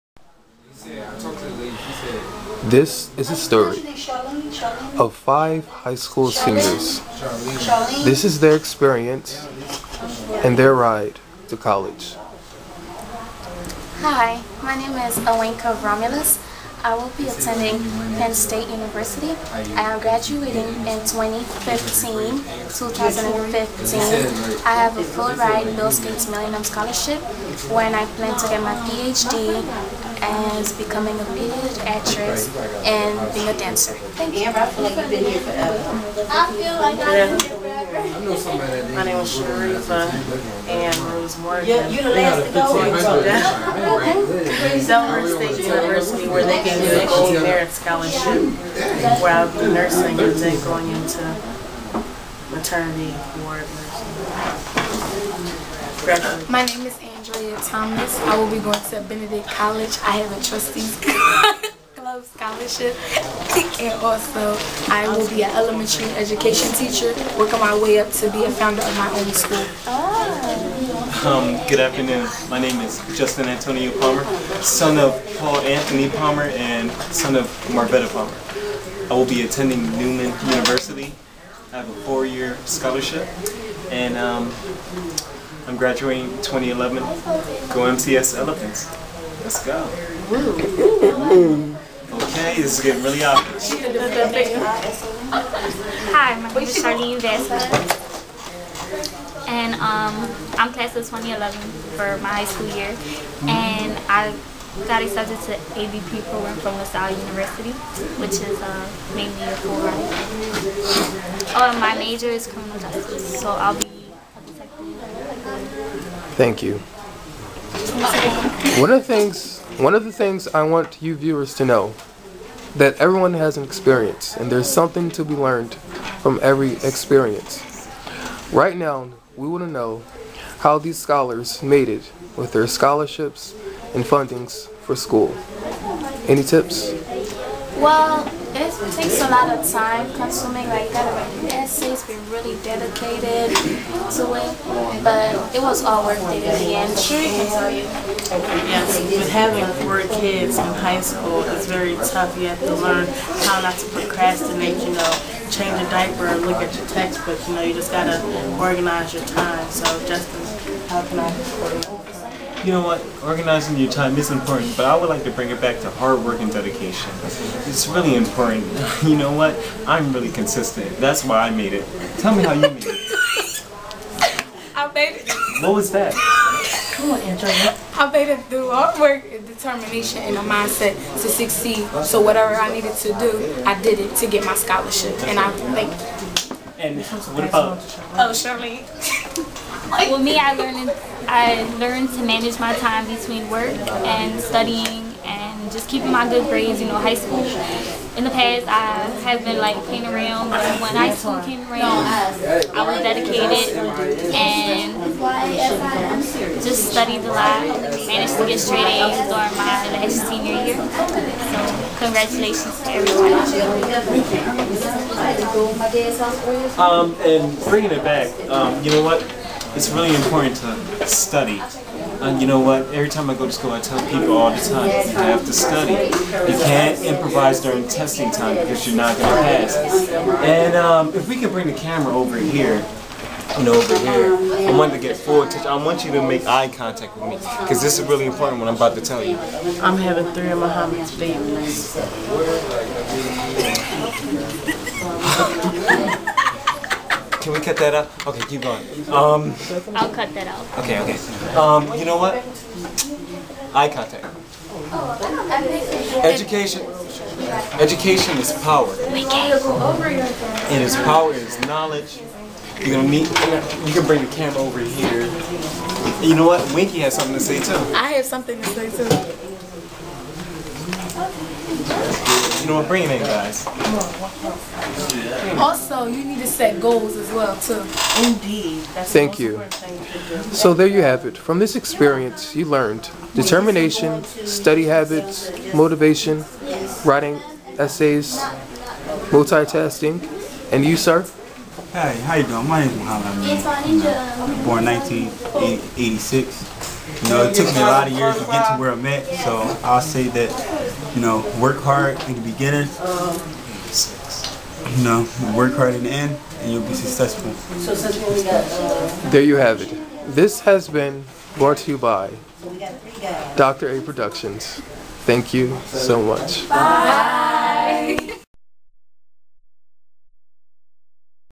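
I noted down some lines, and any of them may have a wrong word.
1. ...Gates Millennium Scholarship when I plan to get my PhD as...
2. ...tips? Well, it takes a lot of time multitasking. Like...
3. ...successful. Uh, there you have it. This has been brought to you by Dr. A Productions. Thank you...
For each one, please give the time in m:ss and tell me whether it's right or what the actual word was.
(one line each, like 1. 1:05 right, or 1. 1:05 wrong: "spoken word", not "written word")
1. 0:25 right
2. 2:16 wrong: "consuming", not "multitasking"
3. 5:06 right.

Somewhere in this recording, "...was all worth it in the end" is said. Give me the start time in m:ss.
2:25.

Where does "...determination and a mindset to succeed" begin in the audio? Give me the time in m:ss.
2:59.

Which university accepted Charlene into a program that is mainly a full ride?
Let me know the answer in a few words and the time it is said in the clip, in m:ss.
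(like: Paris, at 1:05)
LaSalle University, at 1:46.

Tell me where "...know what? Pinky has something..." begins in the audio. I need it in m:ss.
4:26.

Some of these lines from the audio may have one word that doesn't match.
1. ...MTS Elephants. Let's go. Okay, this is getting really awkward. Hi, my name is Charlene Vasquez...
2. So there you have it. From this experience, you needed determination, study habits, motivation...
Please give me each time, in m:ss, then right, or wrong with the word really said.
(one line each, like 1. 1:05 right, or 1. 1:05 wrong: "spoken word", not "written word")
1. 1:27 right
2. 4:40 wrong: "learned", not "needed".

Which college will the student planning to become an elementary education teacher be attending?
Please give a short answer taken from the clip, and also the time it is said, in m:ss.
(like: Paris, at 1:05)
Benedict College, at 0:59.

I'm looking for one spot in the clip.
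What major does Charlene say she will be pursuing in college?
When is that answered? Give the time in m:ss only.
1:52.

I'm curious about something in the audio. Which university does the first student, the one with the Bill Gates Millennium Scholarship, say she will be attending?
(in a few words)
Penn State University.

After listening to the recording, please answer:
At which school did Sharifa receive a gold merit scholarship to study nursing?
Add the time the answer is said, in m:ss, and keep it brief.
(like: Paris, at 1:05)
Delaware State University, at 0:44.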